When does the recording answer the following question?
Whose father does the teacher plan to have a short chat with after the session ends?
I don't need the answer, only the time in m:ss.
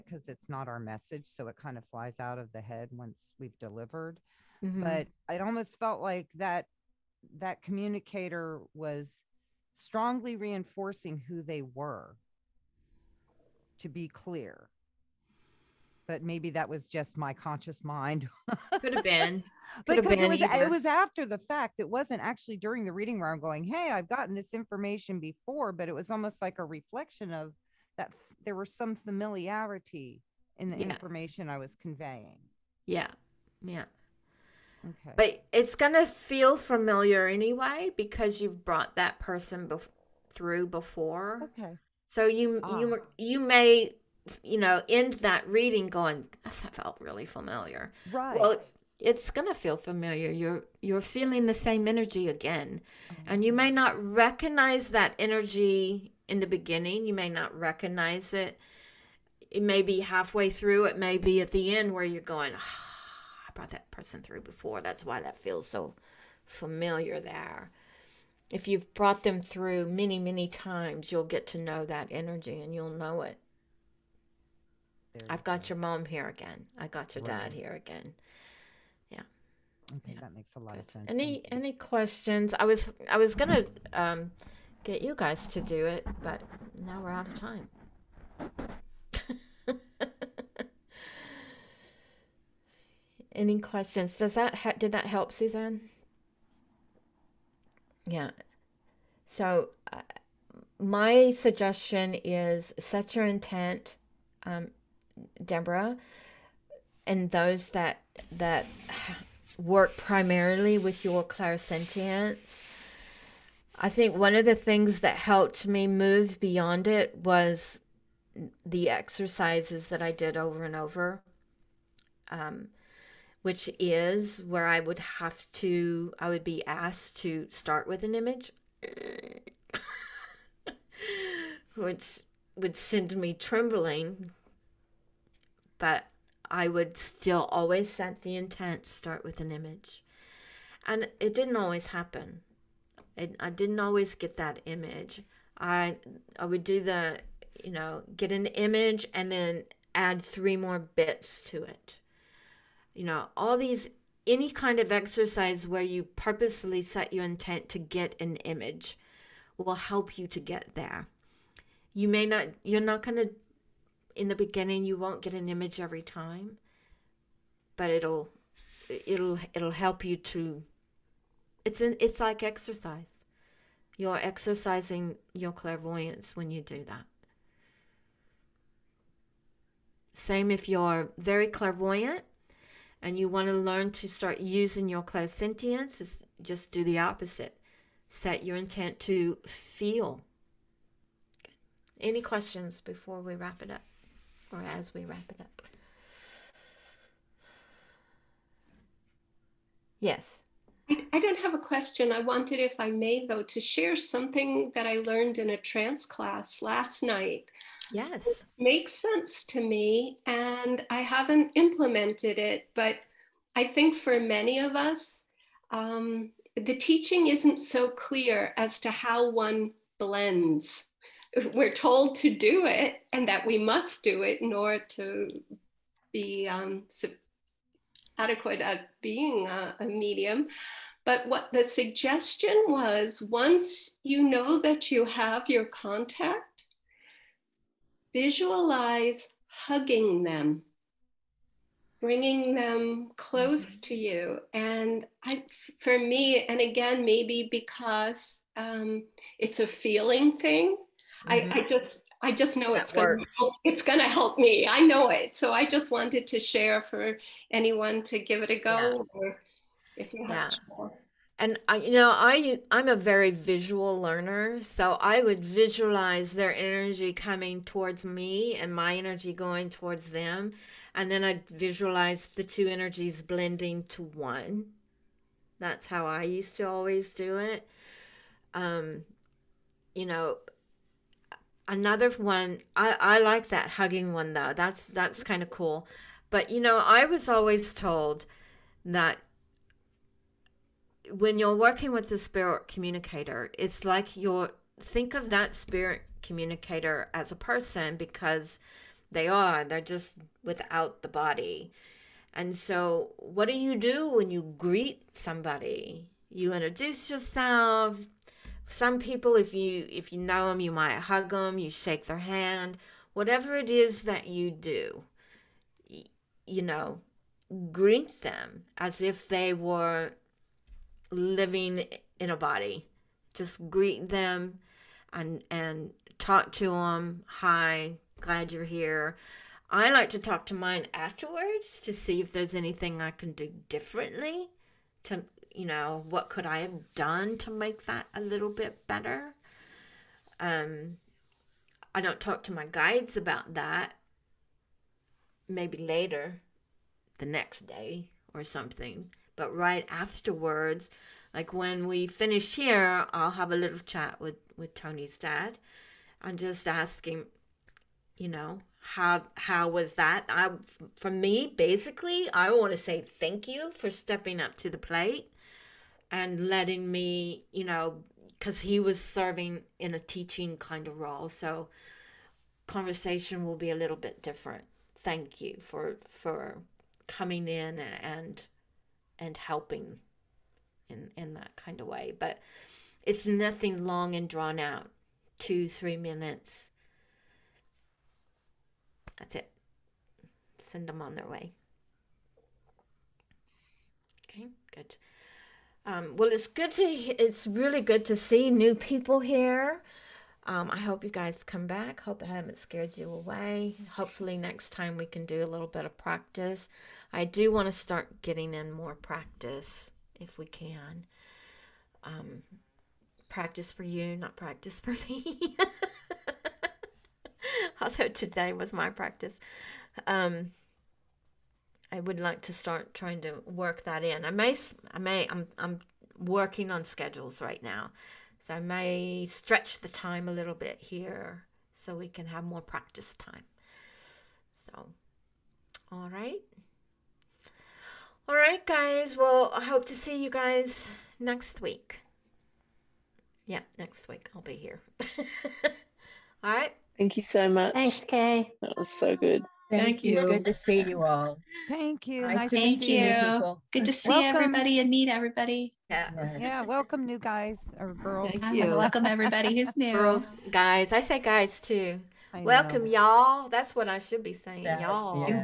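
5:54.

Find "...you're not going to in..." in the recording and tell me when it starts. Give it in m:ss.
2:42.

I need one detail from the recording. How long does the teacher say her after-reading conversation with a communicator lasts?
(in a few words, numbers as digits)
2 to 3 minutes.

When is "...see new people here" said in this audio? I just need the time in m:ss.
6:38.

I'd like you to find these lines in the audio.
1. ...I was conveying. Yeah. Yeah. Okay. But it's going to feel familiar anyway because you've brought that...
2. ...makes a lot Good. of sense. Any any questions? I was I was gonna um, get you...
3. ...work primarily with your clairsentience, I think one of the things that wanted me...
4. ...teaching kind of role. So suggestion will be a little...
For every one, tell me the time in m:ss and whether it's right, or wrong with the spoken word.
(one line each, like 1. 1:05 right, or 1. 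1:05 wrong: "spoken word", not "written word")
1. 0:31 right
2. 1:20 right
3. 1:49 wrong: "helped", not "wanted"
4. 6:09 wrong: "conversation", not "suggestion".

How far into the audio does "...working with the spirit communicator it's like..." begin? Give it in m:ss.
4:51.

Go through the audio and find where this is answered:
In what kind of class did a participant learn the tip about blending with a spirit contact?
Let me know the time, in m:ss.
3:25.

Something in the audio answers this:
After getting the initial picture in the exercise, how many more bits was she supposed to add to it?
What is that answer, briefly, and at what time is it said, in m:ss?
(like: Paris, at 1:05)
3, at 2:30.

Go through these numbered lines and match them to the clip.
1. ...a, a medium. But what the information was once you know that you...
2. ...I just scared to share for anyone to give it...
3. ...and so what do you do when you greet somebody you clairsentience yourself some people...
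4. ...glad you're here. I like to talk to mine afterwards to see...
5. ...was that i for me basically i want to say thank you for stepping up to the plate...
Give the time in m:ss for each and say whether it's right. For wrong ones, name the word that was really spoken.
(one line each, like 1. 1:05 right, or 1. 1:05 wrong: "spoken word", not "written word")
1. 3:49 wrong: "suggestion", not "information"
2. 4:15 wrong: "wanted", not "scared"
3. 5:02 wrong: "introduce", not "clairsentience"
4. 5:28 right
5. 5:59 right.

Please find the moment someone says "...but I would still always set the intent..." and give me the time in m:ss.
2:15.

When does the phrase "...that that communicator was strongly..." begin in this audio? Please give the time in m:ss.
0:06.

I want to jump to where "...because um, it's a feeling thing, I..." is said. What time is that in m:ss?
4:07.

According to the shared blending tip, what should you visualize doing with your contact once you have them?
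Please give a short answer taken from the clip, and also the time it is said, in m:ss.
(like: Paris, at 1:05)
hugging them, at 3:59.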